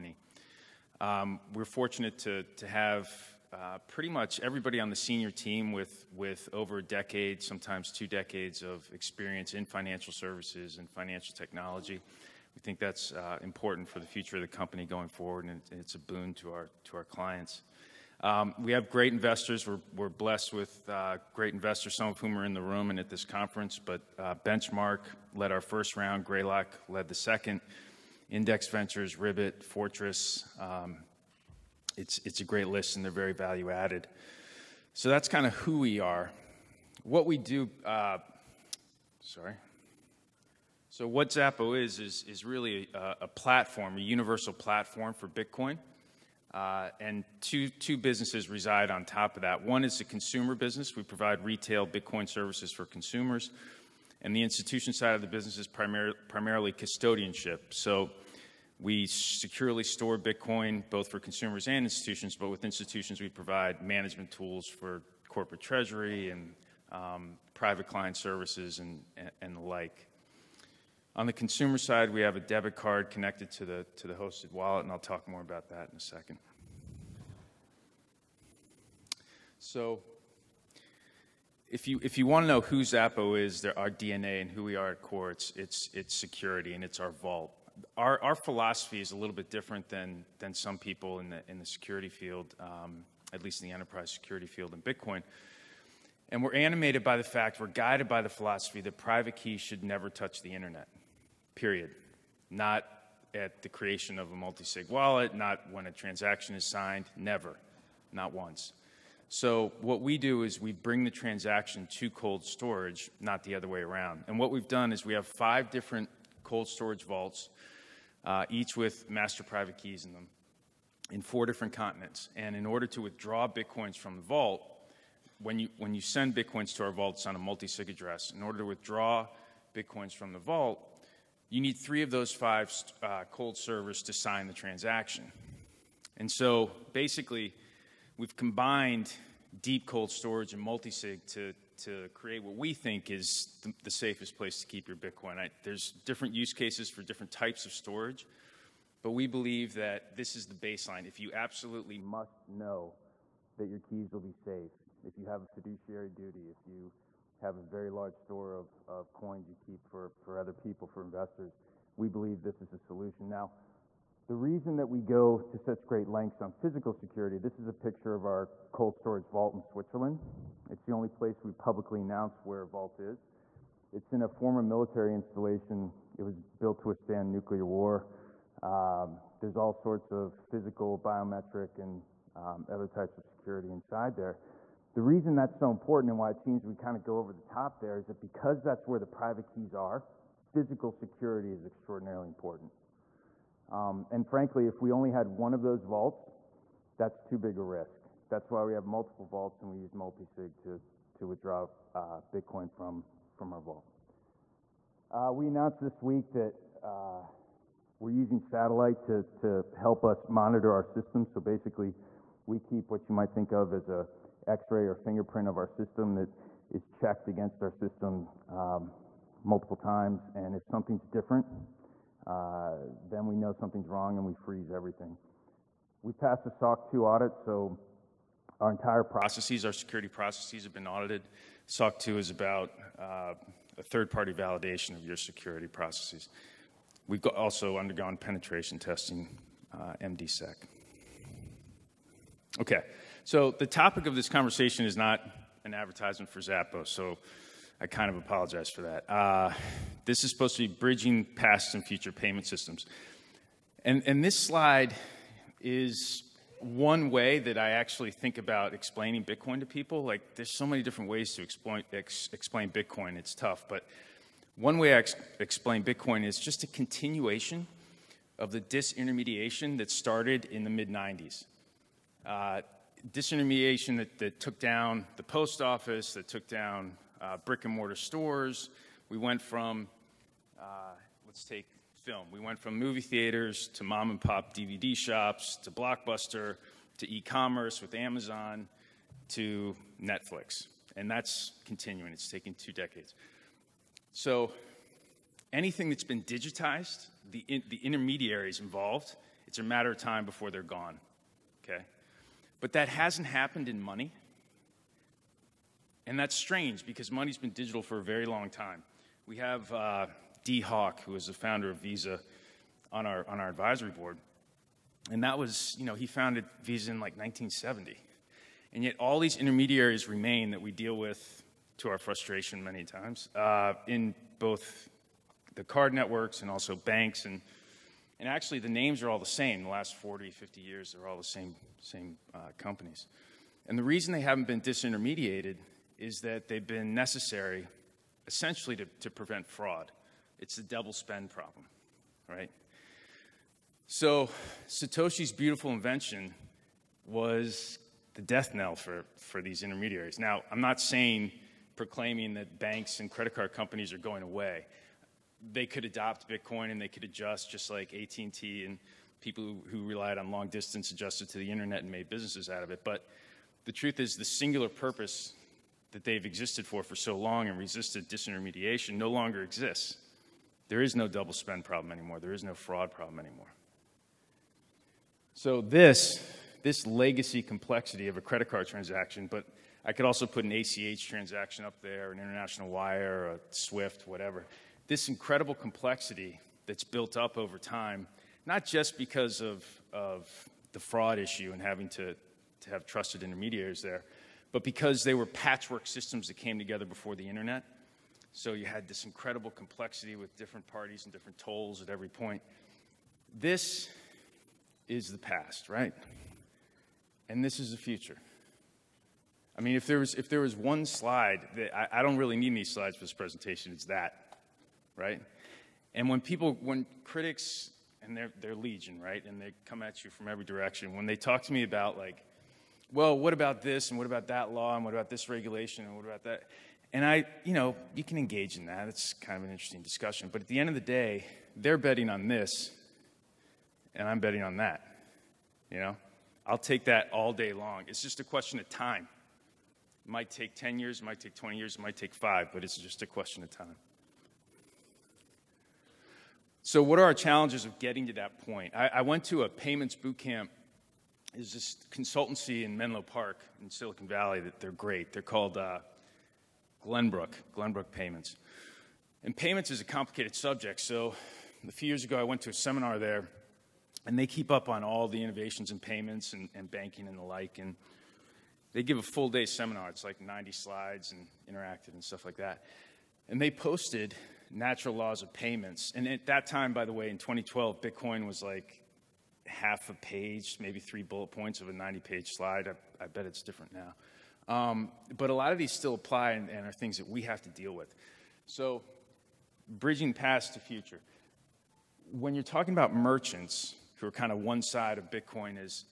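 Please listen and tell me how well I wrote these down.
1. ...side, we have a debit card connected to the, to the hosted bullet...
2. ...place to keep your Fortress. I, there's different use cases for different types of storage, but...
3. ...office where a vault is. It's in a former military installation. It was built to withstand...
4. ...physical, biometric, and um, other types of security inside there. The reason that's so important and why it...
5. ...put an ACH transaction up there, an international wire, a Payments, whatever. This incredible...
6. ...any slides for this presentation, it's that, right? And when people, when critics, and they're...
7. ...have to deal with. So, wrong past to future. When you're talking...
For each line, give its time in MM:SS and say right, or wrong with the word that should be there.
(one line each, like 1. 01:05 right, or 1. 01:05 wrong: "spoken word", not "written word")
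1. 01:11 wrong: "wallet", not "bullet"
2. 02:24 wrong: "Bitcoin", not "Fortress"
3. 02:52 wrong: "announce", not "office"
4. 03:00 right
5. 06:20 wrong: "SWIFT", not "Payments"
6. 06:52 right
7. 08:07 wrong: "bridging", not "wrong".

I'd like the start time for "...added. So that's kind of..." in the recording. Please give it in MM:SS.
00:33.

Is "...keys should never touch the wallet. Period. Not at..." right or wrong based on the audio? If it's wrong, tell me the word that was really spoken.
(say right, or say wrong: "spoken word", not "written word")
wrong: "internet", not "wallet".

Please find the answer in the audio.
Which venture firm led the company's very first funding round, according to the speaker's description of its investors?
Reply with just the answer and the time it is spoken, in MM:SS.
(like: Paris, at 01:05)
Benchmark, at 00:24.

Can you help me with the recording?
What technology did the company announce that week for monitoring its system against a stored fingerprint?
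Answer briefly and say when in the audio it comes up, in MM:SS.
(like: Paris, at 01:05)
Satellite, at 03:28.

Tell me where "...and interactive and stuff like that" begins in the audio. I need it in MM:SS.
07:51.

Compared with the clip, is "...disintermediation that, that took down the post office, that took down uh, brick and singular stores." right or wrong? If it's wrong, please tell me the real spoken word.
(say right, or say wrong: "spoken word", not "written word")
wrong: "mortar", not "singular".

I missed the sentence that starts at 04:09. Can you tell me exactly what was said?
Uh, this is supposed to be bridging past and future payment systems.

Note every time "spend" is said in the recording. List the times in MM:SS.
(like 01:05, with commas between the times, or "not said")
05:40, 06:11.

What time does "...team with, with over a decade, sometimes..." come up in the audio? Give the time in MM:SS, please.
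00:05.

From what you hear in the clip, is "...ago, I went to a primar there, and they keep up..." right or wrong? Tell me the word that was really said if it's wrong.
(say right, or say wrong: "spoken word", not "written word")
wrong: "seminar", not "primar".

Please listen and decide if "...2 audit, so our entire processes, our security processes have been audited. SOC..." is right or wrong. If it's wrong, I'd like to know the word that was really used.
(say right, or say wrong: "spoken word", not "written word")
right.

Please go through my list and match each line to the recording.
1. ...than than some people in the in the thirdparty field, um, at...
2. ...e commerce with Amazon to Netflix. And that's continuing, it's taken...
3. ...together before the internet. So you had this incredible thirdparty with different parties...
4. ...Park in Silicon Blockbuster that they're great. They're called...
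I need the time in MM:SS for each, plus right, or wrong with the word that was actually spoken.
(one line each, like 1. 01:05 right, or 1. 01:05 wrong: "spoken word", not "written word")
1. 01:29 wrong: "security", not "thirdparty"
2. 04:47 right
3. 06:36 wrong: "complexity", not "thirdparty"
4. 07:33 wrong: "Valley", not "Blockbuster".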